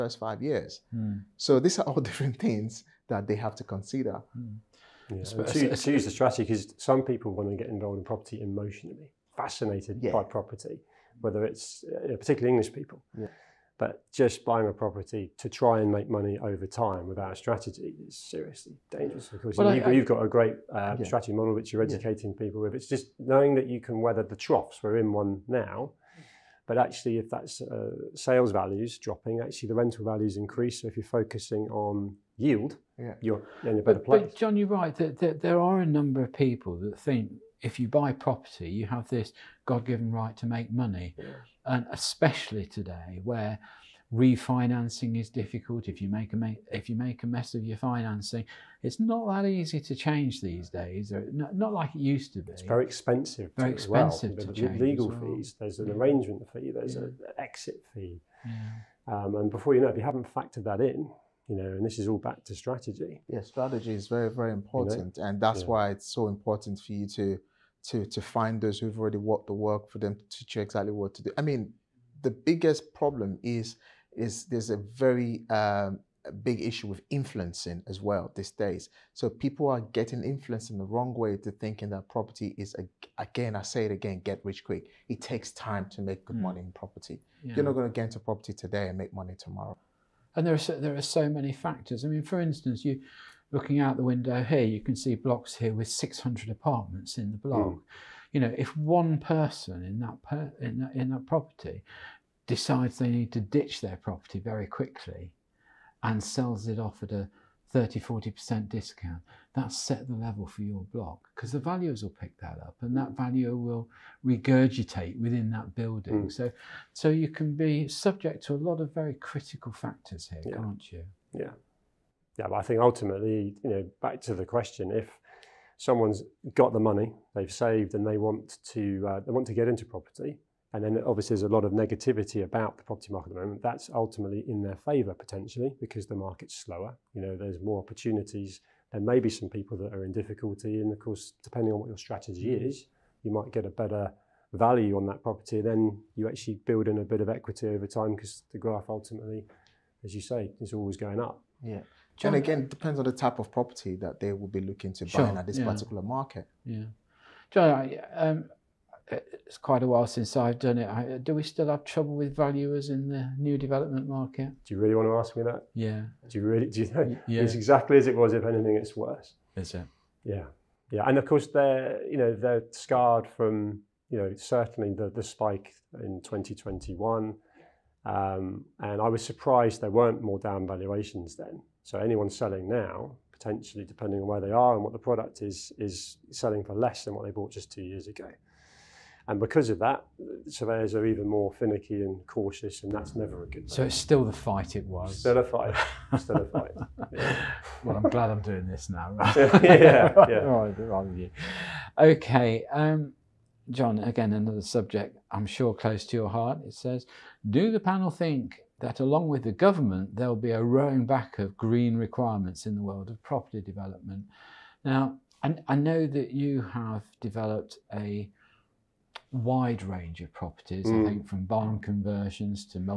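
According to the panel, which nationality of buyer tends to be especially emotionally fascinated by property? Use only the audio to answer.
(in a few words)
English.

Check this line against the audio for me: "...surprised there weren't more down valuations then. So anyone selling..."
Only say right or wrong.
right.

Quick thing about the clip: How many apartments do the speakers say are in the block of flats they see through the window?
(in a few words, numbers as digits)
600.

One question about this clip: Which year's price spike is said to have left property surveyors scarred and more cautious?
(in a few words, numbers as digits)
2021.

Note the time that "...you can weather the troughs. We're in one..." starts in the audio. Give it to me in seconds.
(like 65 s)
23 s.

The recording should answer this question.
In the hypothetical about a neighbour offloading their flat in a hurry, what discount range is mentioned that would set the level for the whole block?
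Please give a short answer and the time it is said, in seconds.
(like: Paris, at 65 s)
30 to 40%, at 107 s.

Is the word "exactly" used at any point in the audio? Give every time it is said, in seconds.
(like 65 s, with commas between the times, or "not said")
70 s, 167 s.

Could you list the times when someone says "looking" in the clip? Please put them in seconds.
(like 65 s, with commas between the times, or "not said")
93 s, 154 s.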